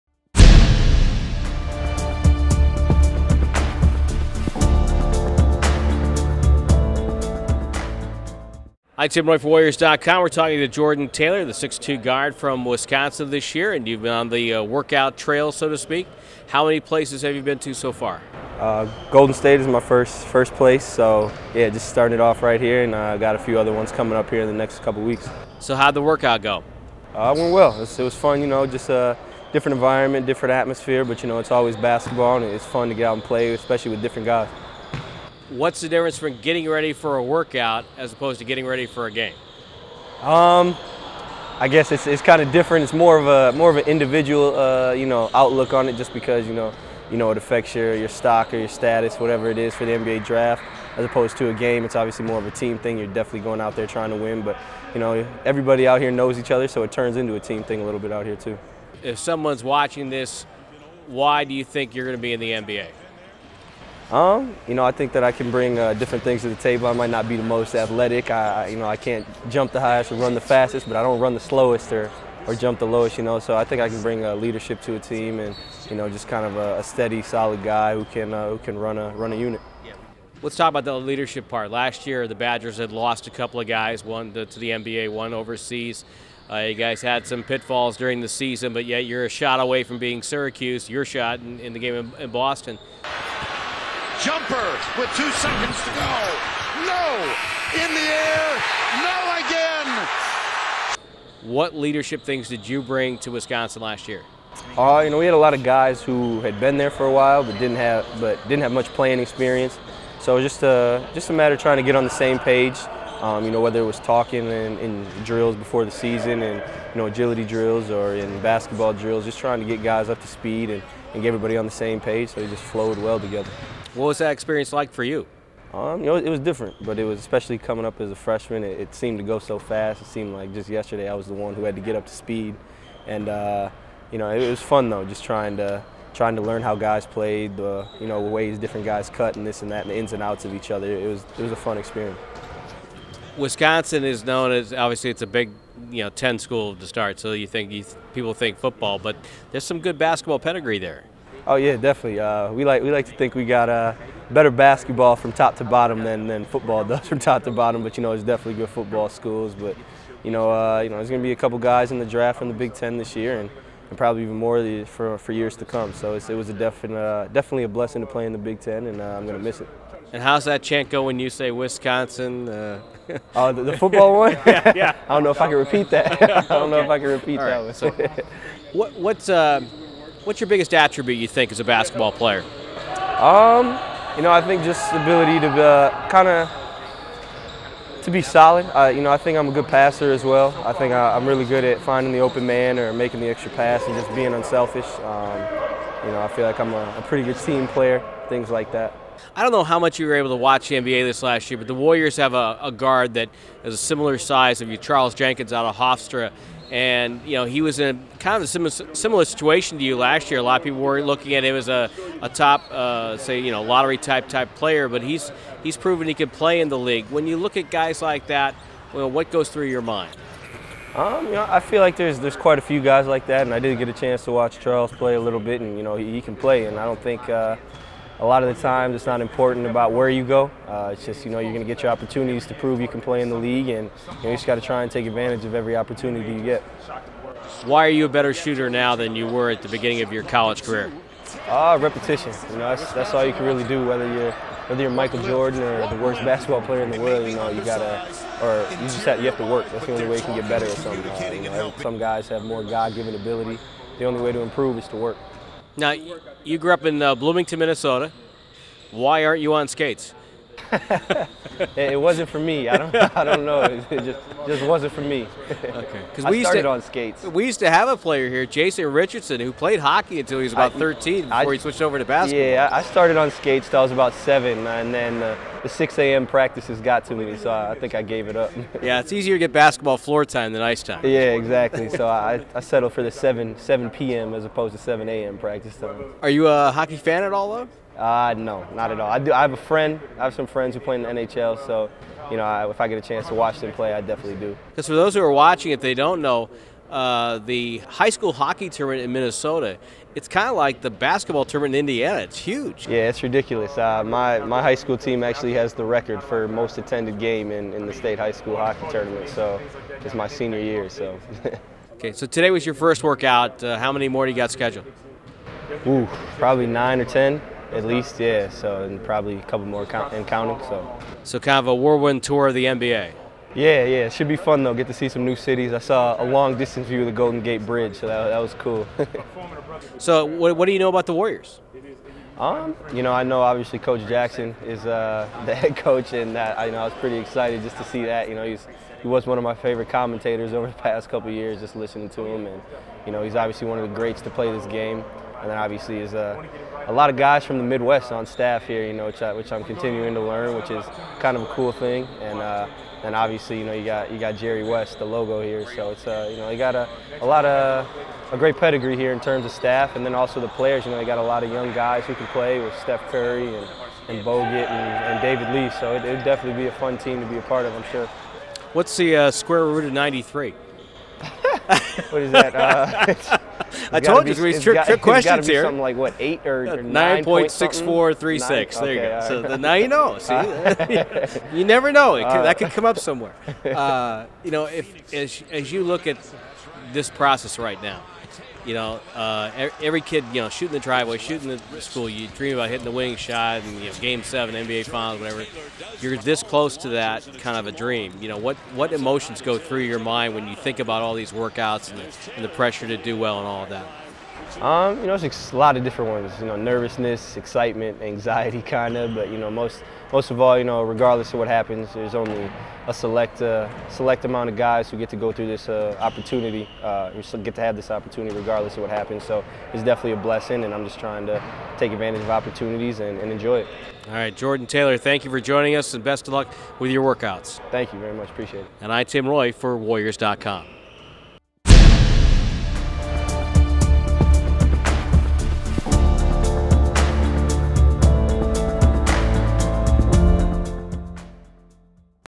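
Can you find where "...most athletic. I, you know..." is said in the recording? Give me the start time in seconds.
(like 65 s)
67 s.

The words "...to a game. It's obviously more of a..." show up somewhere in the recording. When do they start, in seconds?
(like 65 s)
51 s.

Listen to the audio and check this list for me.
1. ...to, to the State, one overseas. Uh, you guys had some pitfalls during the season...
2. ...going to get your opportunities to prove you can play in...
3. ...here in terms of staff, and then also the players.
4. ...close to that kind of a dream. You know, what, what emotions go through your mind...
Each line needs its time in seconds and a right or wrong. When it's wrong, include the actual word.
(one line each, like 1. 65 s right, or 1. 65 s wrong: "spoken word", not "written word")
1. 84 s wrong: "NBA", not "State"
2. 231 s right
3. 358 s right
4. 396 s right.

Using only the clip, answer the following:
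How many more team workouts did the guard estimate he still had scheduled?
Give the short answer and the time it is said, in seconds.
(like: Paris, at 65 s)
9 or 10, at 316 s.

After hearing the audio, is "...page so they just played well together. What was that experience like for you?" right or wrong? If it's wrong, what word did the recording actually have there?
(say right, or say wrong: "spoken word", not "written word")
wrong: "flowed", not "played".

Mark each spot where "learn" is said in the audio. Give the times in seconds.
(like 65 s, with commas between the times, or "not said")
136 s, 350 s.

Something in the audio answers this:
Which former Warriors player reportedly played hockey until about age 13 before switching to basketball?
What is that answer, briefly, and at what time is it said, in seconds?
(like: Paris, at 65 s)
Jason Richardson, at 268 s.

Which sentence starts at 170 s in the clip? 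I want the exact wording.
And how's that chant go when you say Wisconsin?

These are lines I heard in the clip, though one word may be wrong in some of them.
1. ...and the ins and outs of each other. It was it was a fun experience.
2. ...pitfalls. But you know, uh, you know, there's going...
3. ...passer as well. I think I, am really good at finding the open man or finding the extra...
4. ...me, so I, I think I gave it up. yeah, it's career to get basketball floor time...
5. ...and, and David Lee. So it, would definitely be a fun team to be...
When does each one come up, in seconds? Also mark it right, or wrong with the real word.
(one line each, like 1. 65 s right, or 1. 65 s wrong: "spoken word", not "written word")
1. 139 s right
2. 159 s wrong: "schools", not "pitfalls"
3. 189 s wrong: "making", not "finding"
4. 277 s wrong: "easier", not "career"
5. 364 s right.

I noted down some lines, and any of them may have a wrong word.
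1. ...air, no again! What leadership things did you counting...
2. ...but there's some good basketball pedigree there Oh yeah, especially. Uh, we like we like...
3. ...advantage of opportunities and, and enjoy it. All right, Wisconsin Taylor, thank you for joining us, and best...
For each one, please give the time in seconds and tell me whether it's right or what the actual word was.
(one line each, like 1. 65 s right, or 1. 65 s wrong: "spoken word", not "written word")
1. 98 s wrong: "bring", not "counting"
2. 148 s wrong: "definitely", not "especially"
3. 421 s wrong: "Jordan", not "Wisconsin".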